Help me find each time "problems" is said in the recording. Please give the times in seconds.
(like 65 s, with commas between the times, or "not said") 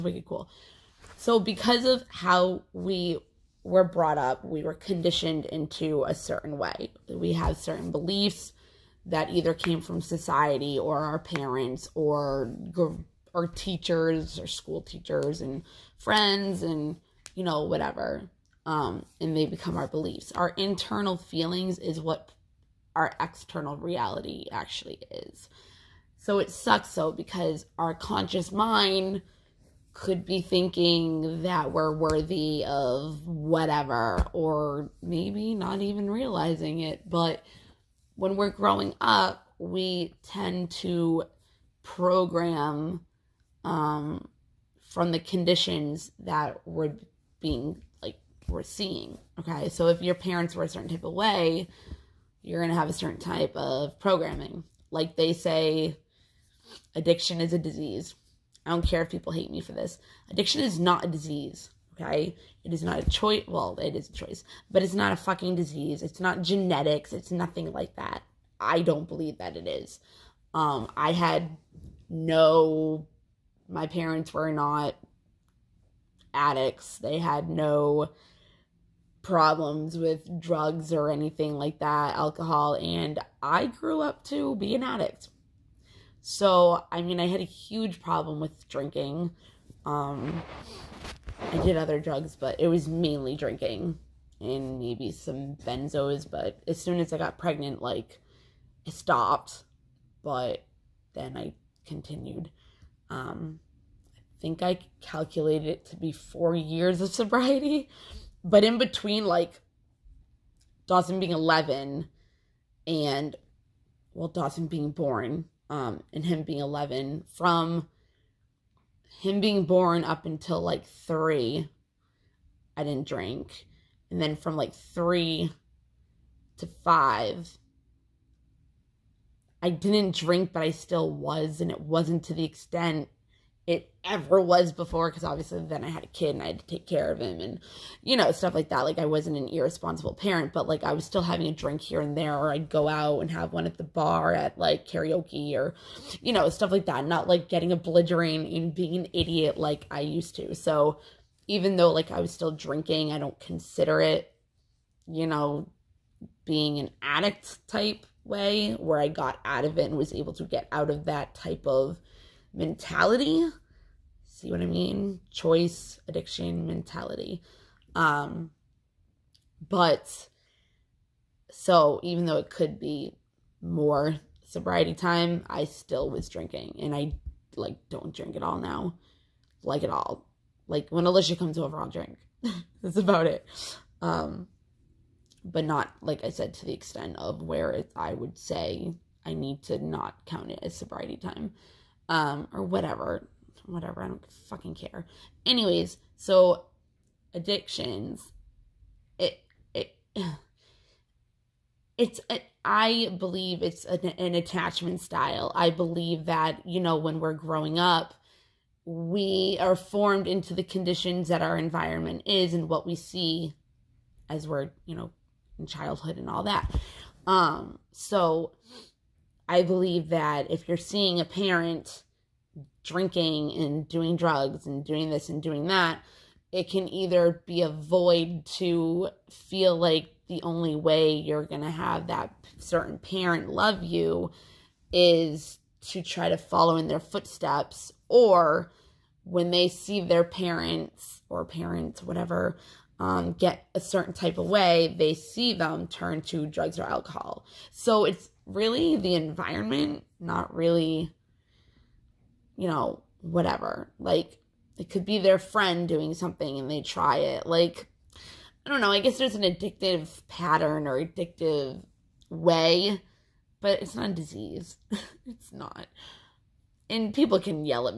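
79 s, 88 s.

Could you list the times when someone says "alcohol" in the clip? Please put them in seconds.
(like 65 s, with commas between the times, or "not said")
82 s, 246 s.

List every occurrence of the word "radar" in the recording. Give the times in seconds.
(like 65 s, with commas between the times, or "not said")
not said.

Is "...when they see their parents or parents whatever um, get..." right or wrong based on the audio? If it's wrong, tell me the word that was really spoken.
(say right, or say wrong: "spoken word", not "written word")
right.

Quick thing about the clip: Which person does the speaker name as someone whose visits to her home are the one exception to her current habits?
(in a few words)
Alicia.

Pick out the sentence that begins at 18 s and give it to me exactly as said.
Um, and they become our beliefs.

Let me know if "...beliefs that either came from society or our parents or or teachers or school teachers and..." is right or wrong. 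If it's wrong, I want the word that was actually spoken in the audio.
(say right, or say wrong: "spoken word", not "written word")
right.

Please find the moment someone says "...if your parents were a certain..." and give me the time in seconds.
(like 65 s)
49 s.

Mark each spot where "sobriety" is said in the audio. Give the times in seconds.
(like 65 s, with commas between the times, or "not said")
107 s, 174 s, 190 s.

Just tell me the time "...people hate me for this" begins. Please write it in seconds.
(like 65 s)
59 s.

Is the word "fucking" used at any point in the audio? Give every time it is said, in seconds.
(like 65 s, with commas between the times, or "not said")
65 s, 194 s.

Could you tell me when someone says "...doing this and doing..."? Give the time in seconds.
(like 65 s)
224 s.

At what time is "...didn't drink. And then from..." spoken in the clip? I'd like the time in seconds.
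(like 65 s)
122 s.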